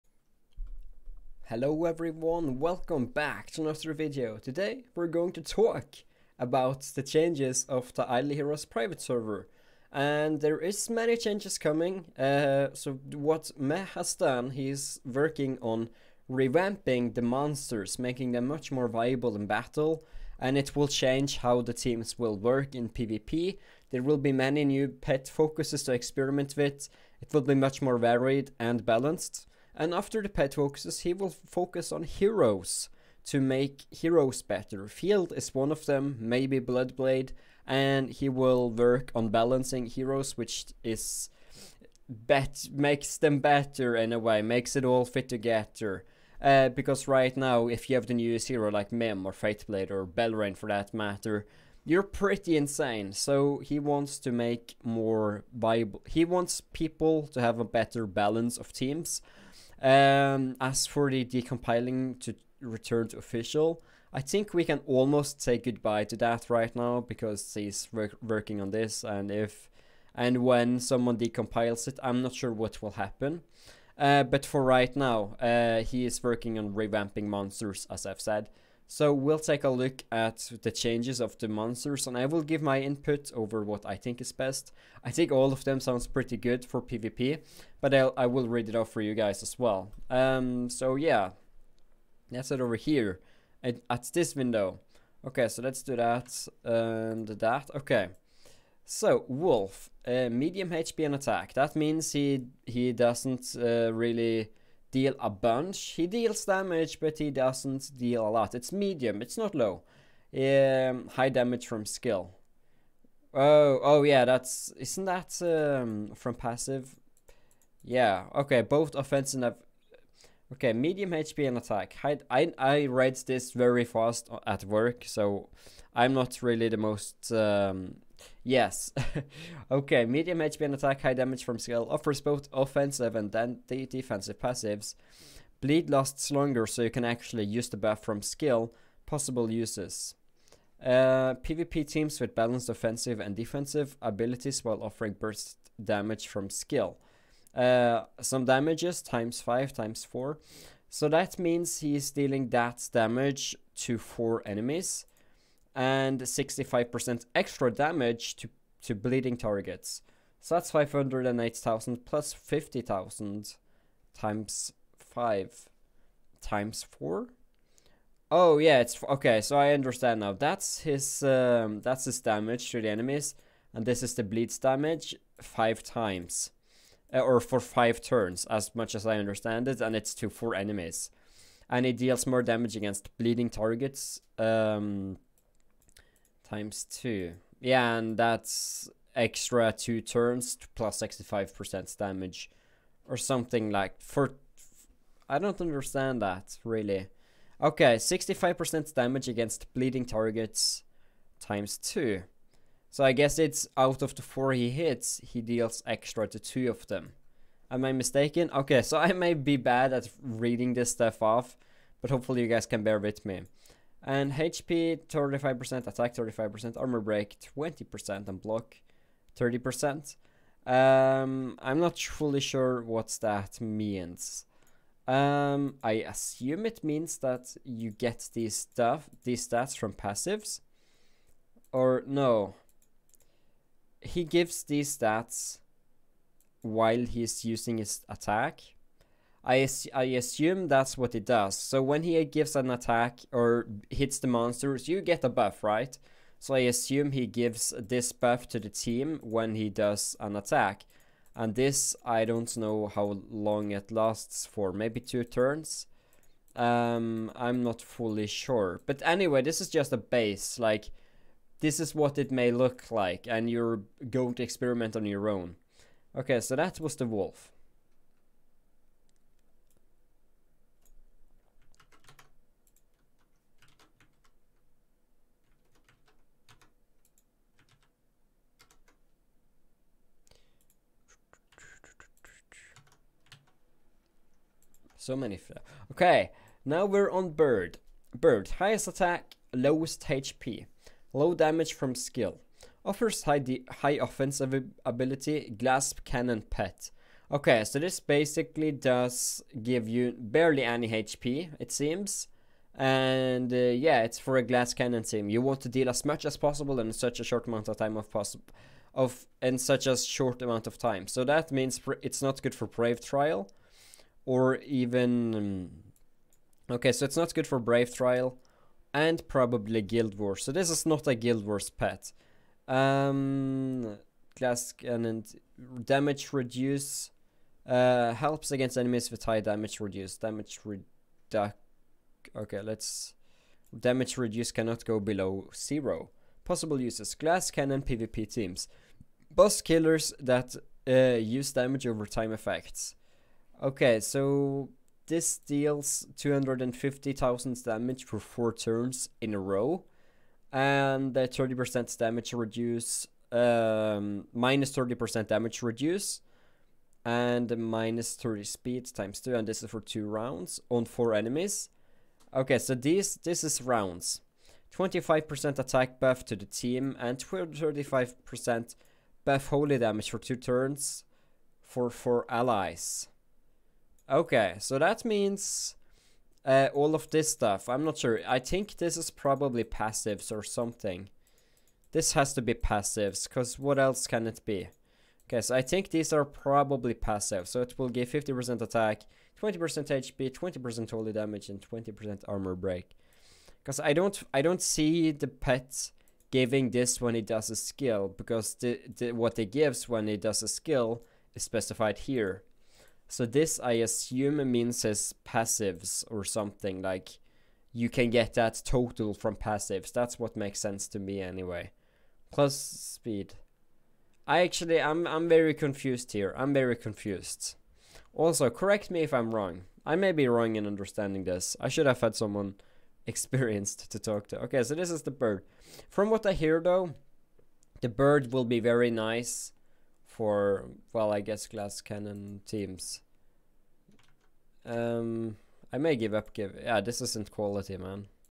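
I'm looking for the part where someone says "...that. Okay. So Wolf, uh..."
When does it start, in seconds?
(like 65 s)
97 s.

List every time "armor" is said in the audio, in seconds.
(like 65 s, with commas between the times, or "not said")
216 s, 392 s.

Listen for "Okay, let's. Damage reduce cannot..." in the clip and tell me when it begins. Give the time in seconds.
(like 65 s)
332 s.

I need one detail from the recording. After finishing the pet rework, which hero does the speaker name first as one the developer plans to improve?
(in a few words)
Field.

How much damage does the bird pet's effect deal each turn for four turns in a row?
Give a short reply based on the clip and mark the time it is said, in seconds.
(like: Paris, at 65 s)
250,000, at 346 s.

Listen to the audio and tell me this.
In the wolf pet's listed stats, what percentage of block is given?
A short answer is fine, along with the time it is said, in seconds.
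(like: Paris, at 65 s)
30%, at 218 s.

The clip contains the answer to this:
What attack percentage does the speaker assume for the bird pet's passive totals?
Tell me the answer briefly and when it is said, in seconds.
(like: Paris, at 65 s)
50%, at 388 s.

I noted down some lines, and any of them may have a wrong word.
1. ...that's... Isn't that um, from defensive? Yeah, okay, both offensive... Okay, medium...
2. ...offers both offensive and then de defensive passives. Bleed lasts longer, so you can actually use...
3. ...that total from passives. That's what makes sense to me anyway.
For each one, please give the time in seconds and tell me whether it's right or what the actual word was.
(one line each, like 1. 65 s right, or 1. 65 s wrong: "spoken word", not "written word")
1. 114 s wrong: "passive", not "defensive"
2. 131 s right
3. 408 s right.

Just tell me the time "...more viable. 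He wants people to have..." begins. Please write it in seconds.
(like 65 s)
54 s.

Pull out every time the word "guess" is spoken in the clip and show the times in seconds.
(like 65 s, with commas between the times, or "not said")
203 s, 431 s.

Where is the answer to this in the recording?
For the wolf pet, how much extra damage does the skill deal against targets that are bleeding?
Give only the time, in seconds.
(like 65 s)
156 s.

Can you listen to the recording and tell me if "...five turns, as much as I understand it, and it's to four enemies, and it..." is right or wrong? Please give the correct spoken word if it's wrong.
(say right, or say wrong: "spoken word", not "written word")
right.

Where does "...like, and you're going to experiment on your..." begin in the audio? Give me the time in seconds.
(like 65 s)
262 s.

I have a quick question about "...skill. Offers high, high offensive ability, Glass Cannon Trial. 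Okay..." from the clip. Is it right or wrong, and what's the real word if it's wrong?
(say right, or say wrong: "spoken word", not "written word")
wrong: "Pet", not "Trial".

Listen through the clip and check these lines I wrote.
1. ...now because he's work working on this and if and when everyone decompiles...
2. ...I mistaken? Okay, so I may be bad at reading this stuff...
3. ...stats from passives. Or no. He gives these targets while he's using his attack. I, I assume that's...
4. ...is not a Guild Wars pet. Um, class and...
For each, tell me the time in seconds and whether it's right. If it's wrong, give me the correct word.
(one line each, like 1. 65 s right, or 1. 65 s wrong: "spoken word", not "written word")
1. 66 s wrong: "someone", not "everyone"
2. 207 s right
3. 229 s wrong: "stats", not "targets"
4. 320 s right.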